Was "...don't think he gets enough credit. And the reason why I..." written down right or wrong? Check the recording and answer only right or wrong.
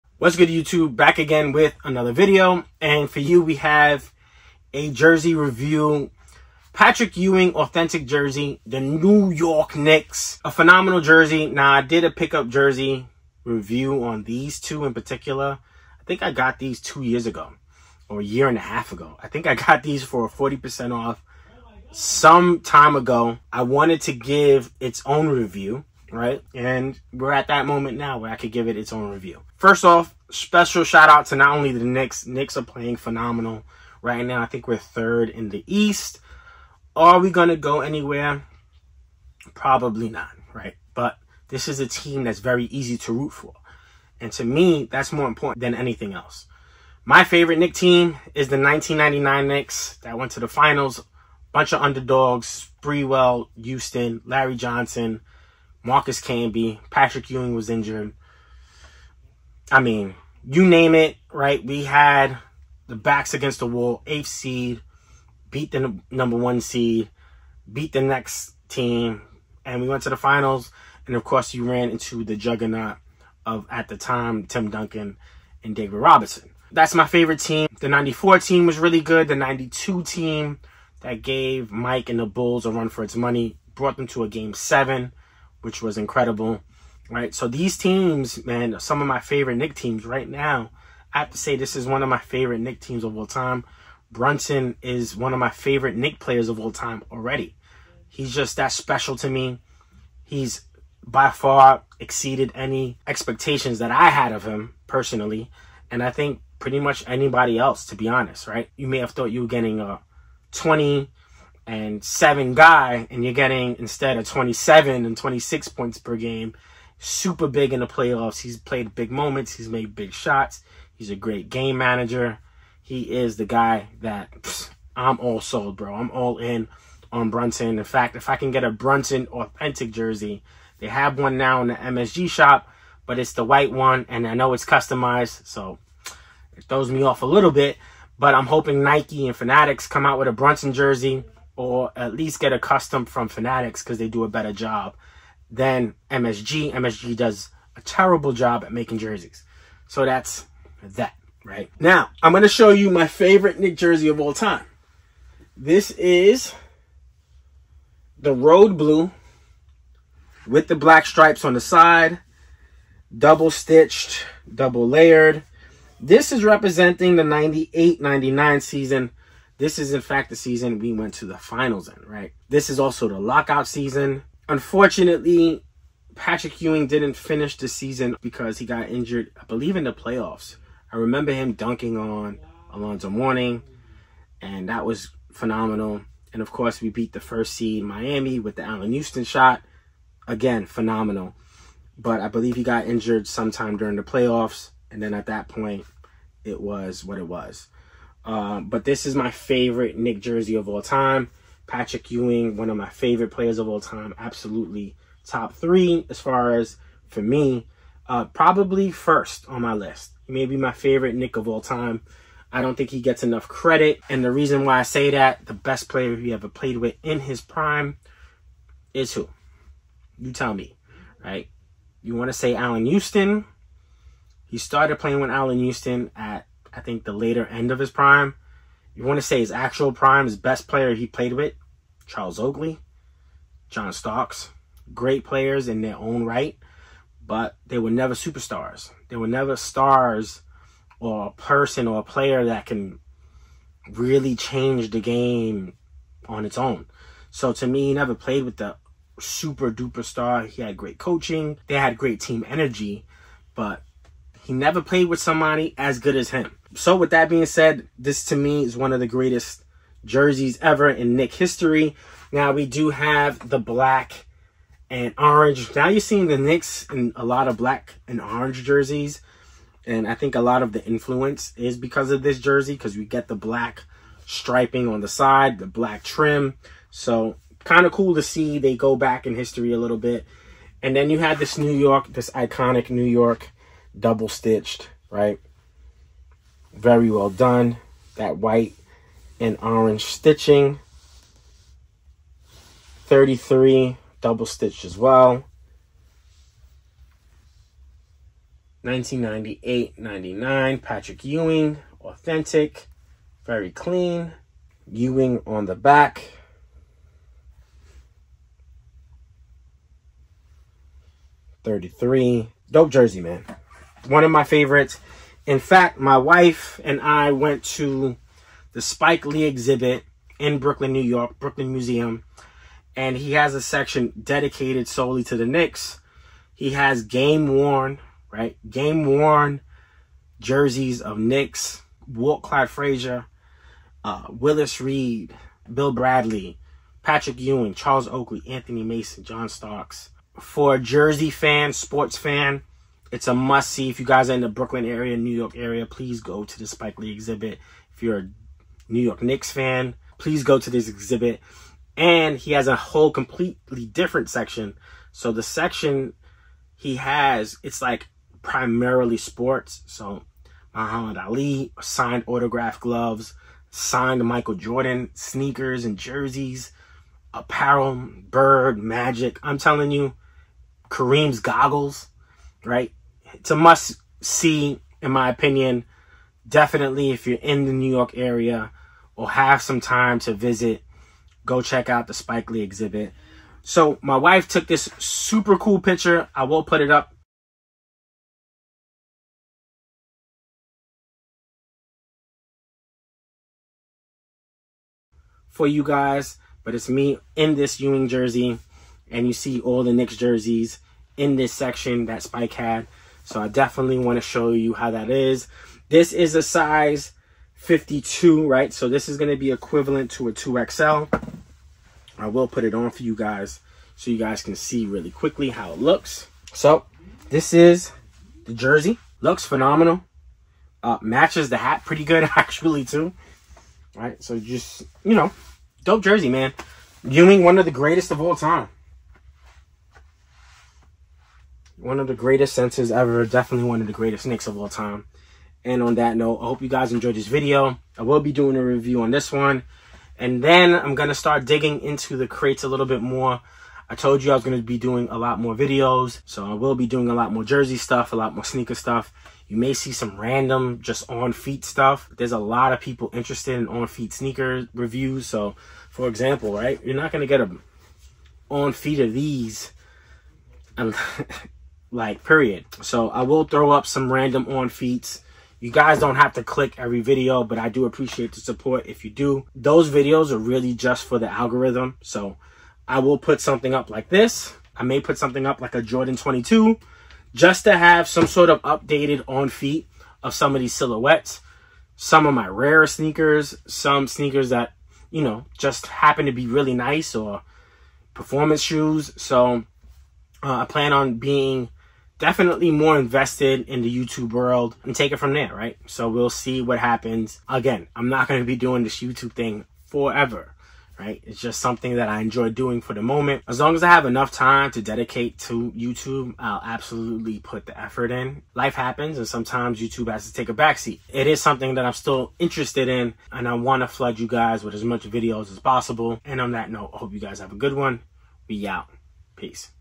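right.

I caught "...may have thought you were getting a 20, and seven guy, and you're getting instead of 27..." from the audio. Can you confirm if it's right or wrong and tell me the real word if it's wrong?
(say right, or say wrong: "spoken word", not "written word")
right.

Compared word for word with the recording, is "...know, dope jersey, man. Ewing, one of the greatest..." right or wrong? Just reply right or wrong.
right.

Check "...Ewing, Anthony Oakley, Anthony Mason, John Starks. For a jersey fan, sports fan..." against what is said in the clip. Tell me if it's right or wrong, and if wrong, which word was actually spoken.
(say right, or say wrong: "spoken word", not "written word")
wrong: "Charles", not "Anthony".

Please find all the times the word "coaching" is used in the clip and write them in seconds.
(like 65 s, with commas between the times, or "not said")
250 s.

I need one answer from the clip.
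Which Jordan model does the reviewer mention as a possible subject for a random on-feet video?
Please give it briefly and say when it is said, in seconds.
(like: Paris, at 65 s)
Jordan 22, at 475 s.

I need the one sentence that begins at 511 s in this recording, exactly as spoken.
It is something that I'm still interested in and I want to flood you guys with as much videos as possible.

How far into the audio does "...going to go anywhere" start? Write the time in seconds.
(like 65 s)
37 s.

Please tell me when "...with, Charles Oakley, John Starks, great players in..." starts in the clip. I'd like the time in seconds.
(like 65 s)
231 s.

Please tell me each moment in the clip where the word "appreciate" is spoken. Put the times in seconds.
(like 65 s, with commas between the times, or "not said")
467 s.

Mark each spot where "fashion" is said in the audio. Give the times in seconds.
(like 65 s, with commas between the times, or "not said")
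not said.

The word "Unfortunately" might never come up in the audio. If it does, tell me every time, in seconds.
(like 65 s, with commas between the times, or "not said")
174 s.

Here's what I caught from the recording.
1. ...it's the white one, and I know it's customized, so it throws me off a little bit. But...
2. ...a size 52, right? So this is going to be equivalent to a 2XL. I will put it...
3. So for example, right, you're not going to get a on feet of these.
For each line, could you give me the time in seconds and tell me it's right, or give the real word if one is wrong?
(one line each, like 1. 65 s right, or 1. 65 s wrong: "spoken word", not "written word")
1. 133 s right
2. 406 s right
3. 455 s right.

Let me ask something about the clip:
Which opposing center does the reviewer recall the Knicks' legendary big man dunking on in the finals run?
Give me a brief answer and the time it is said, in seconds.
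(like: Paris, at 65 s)
Alonzo Mourning, at 182 s.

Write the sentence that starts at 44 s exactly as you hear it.
And to me, that's more important than anything else.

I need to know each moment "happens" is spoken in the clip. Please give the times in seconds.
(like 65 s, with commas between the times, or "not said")
485 s, 496 s, 508 s.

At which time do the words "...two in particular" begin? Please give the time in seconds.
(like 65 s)
14 s.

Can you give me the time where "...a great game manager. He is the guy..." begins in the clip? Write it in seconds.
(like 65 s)
121 s.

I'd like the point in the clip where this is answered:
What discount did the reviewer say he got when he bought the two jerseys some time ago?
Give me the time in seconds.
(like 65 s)
20 s.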